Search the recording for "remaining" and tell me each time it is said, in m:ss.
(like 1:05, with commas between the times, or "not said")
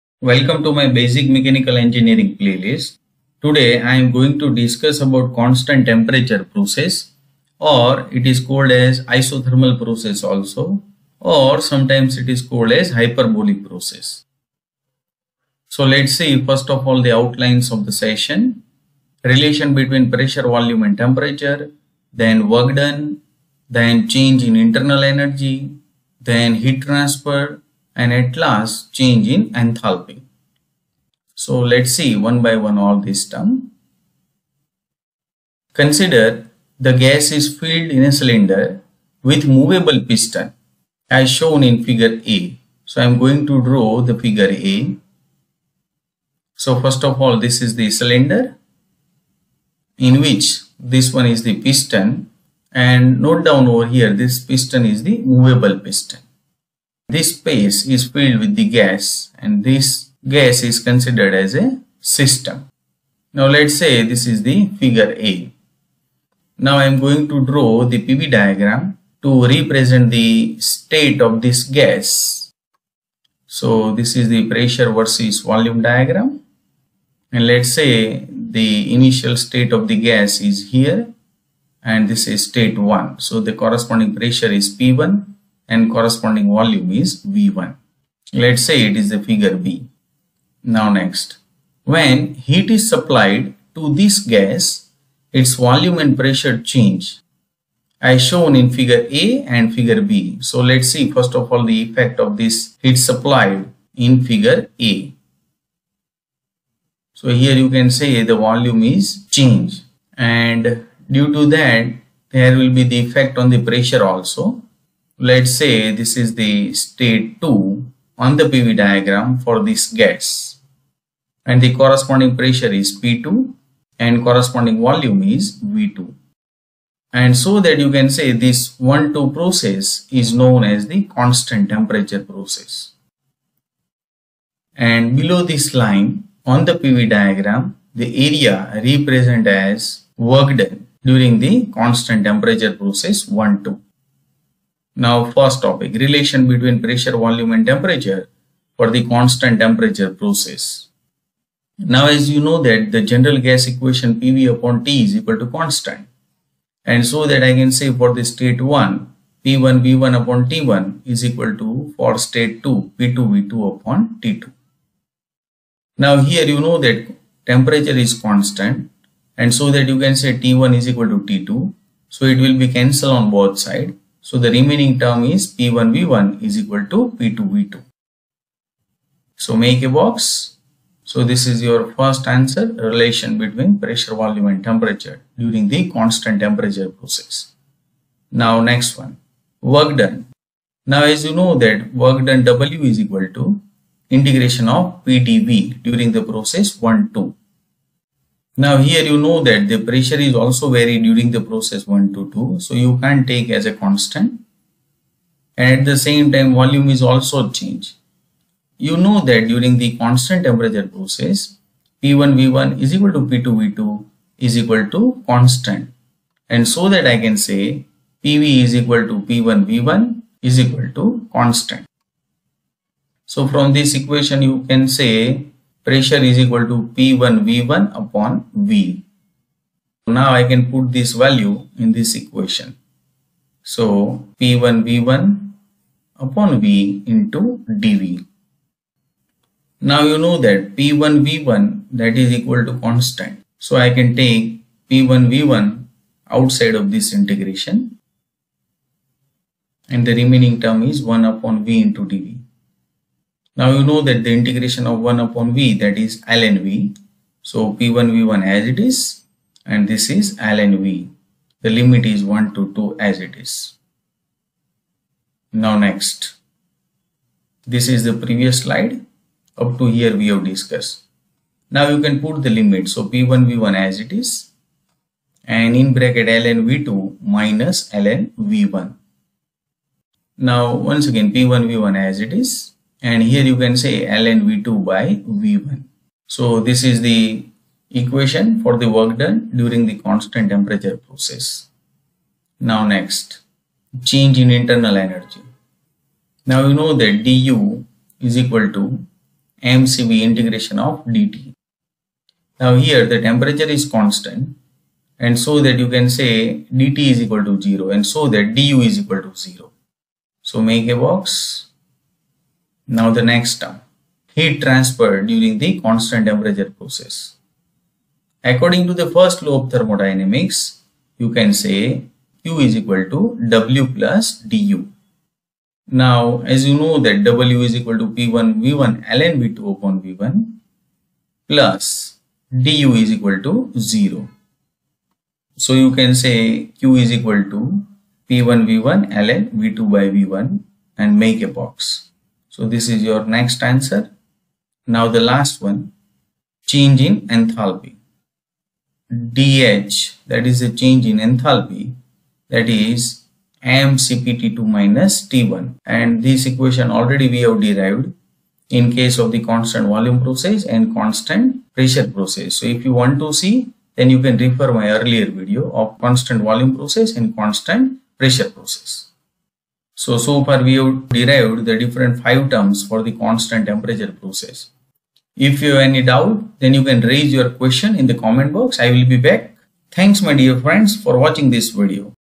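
2:54, 4:10.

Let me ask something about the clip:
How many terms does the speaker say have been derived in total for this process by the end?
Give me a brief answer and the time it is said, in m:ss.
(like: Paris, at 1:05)
5, at 6:12.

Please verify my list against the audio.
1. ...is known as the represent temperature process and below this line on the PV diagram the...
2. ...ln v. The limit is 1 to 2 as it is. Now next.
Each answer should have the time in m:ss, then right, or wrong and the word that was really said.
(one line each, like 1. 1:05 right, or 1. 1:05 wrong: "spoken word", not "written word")
1. 2:10 wrong: "constant", not "represent"
2. 4:20 right.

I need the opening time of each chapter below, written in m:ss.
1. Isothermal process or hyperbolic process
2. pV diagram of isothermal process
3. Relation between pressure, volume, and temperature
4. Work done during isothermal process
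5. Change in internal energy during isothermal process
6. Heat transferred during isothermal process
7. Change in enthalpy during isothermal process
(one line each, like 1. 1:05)
1. 0:33
2. 1:12
3. 2:23
4. 3:07
5. 4:51
6. 5:12
7. 5:44.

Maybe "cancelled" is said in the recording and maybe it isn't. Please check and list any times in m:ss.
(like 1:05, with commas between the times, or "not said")
2:52.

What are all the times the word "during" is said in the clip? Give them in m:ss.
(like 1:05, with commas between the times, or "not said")
2:21, 3:05, 3:15, 3:21, 3:29, 4:49, 5:15.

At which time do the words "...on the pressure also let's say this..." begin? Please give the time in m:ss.
1:53.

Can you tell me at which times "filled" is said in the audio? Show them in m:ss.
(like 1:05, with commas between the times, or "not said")
0:37, 0:58.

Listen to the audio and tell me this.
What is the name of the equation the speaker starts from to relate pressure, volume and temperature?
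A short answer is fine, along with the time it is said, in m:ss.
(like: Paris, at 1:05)
General gas equation, at 2:33.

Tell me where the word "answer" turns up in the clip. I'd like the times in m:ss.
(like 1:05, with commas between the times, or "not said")
3:02, 5:43.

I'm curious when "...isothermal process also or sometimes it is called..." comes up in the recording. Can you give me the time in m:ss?
0:09.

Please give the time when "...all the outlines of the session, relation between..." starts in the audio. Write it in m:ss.
0:16.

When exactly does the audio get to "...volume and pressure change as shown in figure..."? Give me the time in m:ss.
1:35.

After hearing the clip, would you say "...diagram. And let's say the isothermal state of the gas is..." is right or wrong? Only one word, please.
wrong.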